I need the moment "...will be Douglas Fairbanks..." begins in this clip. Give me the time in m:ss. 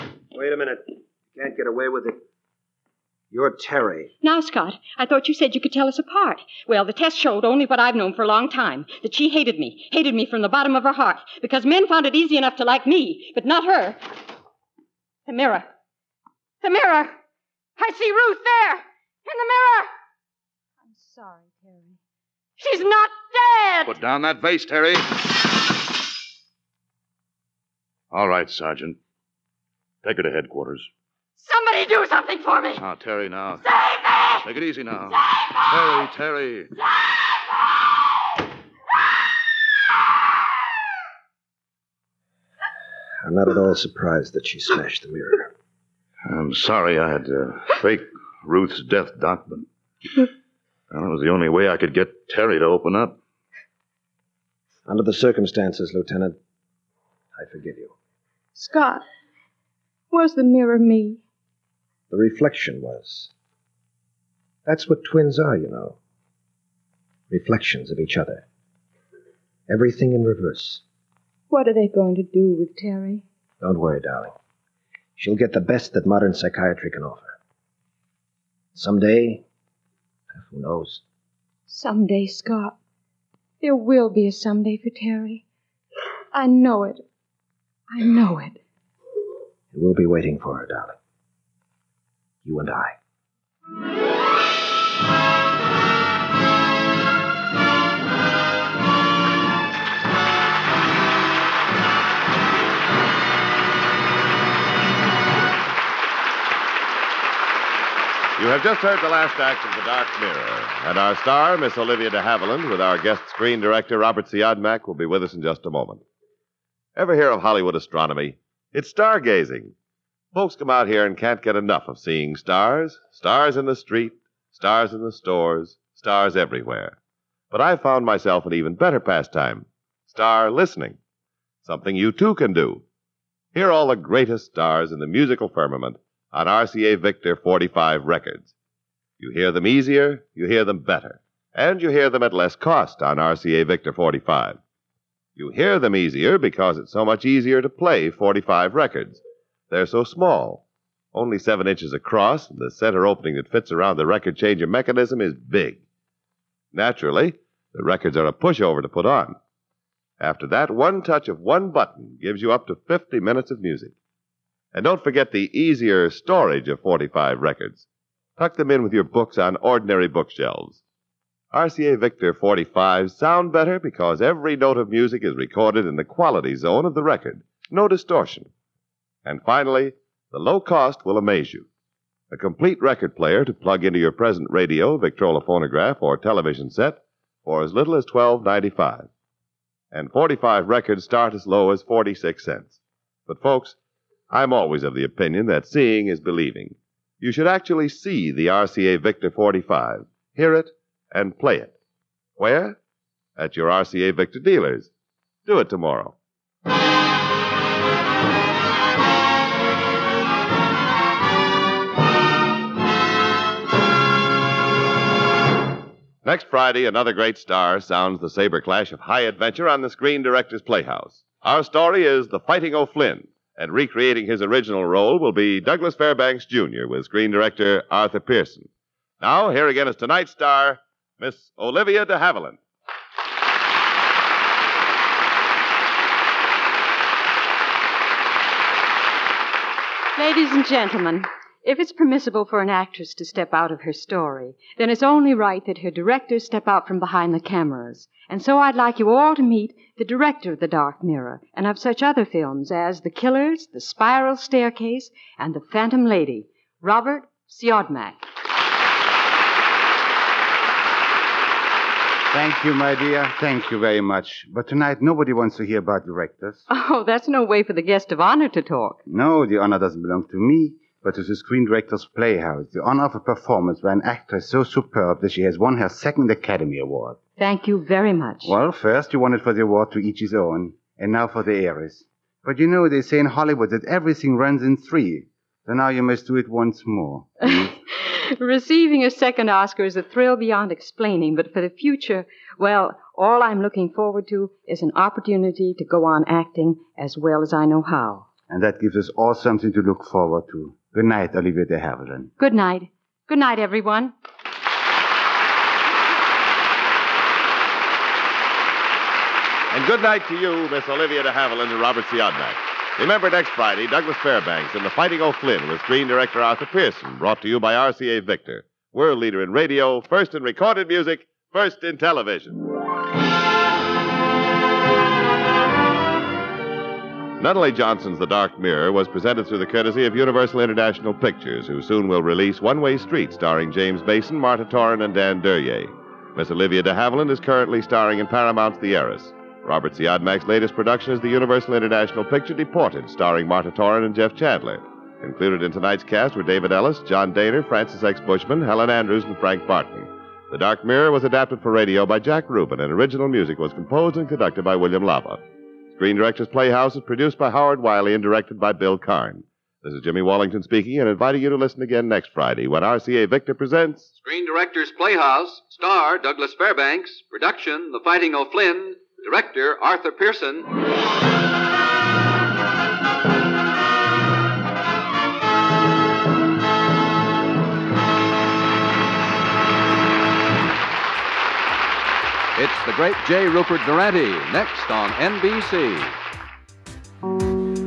3:45.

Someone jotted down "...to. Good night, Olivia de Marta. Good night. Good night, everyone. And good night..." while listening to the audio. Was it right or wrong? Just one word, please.
wrong.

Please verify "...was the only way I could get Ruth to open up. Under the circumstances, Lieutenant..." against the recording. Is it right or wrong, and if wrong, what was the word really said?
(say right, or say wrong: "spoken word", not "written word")
wrong: "Terry", not "Ruth".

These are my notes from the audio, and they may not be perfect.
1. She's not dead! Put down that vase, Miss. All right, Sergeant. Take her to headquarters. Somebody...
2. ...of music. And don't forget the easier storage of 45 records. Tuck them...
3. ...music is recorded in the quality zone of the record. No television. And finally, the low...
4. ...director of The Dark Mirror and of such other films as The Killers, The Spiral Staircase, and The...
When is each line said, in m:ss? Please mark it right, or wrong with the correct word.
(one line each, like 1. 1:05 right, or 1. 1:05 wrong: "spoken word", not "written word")
1. 0:22 wrong: "Terry", not "Miss"
2. 2:43 right
3. 2:54 wrong: "distortion", not "television"
4. 4:10 right.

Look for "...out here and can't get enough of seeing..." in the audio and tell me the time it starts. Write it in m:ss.
2:00.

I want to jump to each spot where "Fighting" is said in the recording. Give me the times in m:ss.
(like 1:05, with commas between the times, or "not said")
3:42, 5:14, 6:08.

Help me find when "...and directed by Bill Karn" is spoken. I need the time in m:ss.
5:58.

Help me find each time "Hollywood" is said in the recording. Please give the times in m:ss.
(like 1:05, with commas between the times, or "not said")
1:57, 4:43.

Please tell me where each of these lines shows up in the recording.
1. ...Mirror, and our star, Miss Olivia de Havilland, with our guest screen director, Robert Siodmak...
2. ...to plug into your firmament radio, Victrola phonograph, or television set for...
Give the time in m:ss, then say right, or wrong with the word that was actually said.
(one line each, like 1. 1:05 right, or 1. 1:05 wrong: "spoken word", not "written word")
1. 1:50 right
2. 3:03 wrong: "present", not "firmament".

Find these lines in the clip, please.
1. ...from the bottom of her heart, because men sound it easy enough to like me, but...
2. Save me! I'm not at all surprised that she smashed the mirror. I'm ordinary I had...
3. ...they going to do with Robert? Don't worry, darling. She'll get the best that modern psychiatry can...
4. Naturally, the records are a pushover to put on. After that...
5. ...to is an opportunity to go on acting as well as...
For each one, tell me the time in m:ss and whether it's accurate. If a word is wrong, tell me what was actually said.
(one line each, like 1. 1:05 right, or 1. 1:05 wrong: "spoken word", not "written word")
1. 0:10 wrong: "found", not "sound"
2. 0:36 wrong: "sorry", not "ordinary"
3. 1:11 wrong: "Terry", not "Robert"
4. 2:36 right
5. 4:54 right.